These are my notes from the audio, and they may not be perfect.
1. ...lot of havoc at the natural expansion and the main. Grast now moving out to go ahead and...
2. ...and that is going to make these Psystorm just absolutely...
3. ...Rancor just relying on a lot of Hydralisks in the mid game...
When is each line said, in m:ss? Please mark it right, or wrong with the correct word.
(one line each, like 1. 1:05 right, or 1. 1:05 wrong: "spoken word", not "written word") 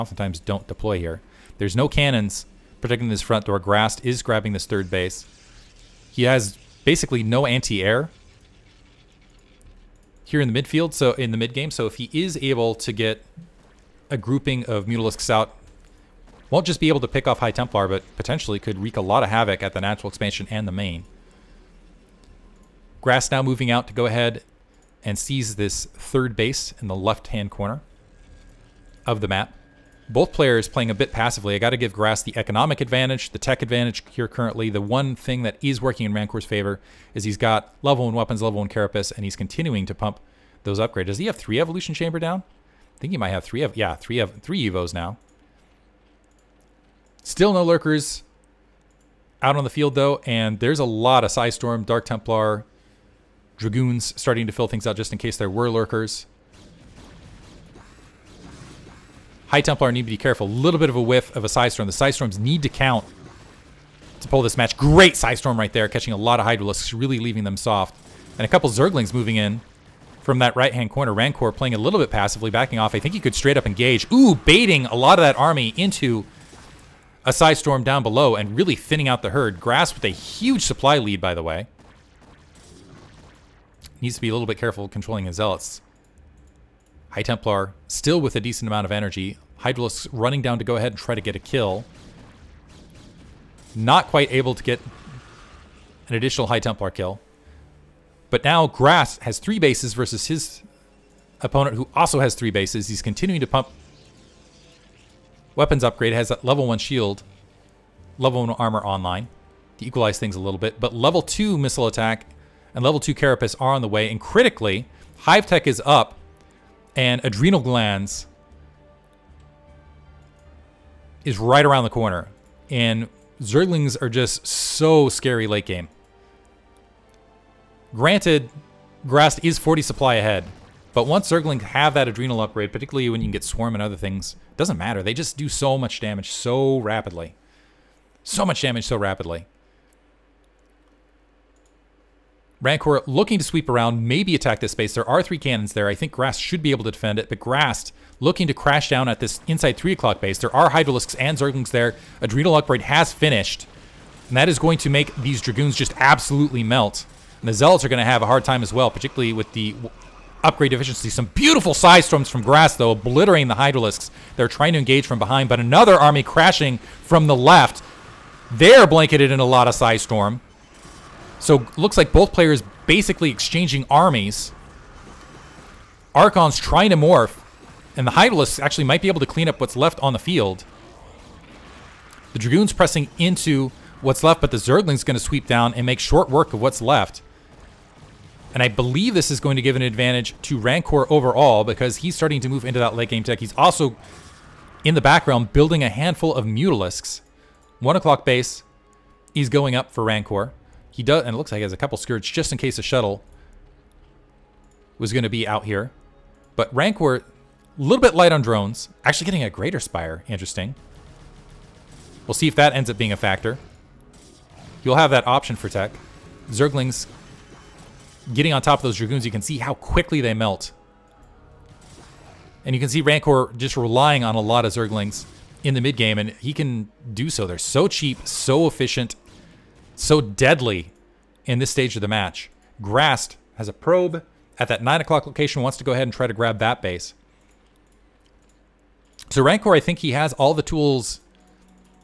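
1. 0:19 right
2. 2:34 wrong: "Dragoons", not "Psystorm"
3. 3:43 wrong: "Zerglings", not "Hydralisks".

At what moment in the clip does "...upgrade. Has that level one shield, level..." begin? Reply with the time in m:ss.
1:45.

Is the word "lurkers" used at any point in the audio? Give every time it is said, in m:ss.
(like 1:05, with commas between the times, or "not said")
0:47, 0:55.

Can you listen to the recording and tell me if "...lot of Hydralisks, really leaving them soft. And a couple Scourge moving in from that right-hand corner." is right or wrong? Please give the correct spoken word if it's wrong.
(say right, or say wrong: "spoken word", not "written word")
wrong: "Zerglings", not "Scourge".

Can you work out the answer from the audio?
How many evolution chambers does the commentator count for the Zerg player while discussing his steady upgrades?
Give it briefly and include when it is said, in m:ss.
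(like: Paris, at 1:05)
3, at 0:43.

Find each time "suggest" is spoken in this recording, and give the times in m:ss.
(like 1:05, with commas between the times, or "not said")
not said.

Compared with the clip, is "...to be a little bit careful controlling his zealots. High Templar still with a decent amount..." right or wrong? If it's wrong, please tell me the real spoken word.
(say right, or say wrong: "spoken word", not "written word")
right.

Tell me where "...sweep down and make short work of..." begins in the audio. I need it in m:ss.
3:05.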